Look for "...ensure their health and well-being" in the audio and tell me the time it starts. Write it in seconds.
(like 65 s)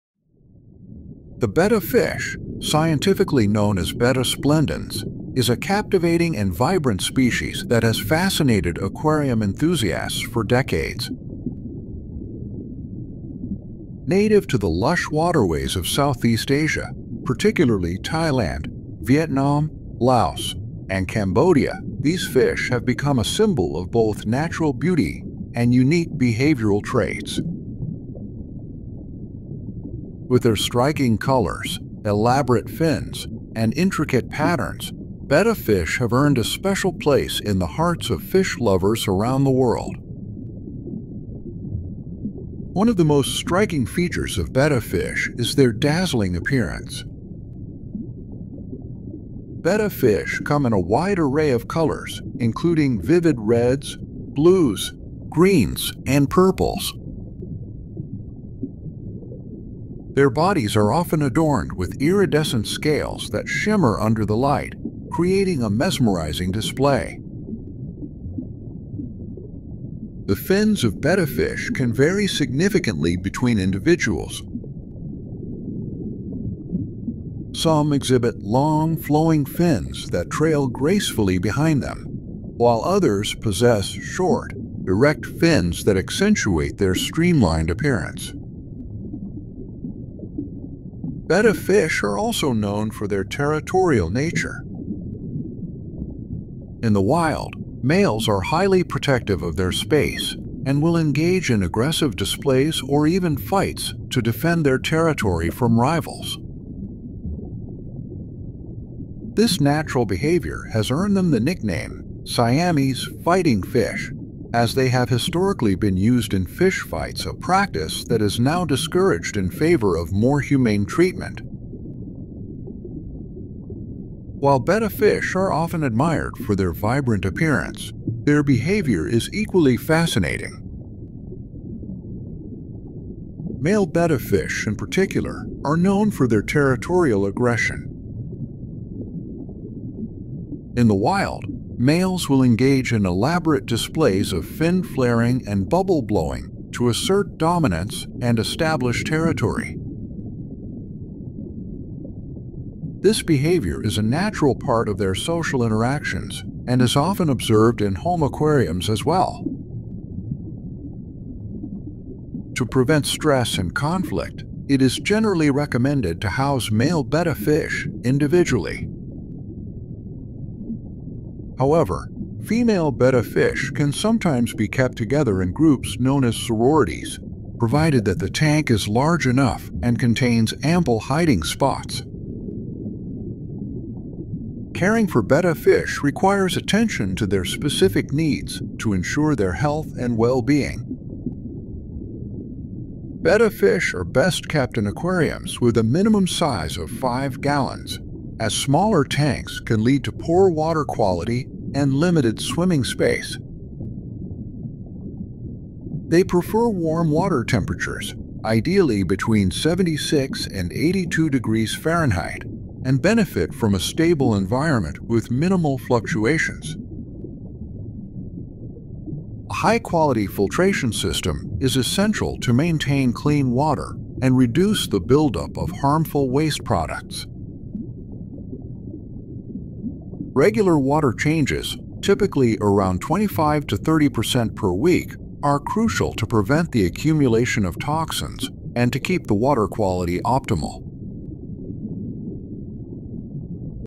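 188 s.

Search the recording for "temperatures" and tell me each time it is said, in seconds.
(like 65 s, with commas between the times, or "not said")
207 s.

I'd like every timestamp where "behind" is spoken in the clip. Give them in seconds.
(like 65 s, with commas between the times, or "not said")
81 s.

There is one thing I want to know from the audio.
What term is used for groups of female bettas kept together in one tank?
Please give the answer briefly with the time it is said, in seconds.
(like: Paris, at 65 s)
sororities, at 176 s.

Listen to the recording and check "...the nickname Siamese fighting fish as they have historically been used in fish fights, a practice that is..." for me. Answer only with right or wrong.
right.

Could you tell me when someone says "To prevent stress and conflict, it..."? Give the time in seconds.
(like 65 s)
162 s.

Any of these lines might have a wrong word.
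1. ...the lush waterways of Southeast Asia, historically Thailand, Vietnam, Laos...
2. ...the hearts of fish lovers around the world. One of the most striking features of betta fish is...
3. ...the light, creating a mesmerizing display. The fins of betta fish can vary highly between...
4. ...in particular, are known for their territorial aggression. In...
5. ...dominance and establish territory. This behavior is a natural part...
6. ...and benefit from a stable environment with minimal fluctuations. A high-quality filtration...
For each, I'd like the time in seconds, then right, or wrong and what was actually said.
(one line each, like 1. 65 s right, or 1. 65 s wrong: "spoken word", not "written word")
1. 14 s wrong: "particularly", not "historically"
2. 37 s right
3. 64 s wrong: "significantly", not "highly"
4. 134 s right
5. 147 s right
6. 212 s right.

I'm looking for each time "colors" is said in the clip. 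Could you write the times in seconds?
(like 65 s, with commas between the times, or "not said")
31 s, 51 s.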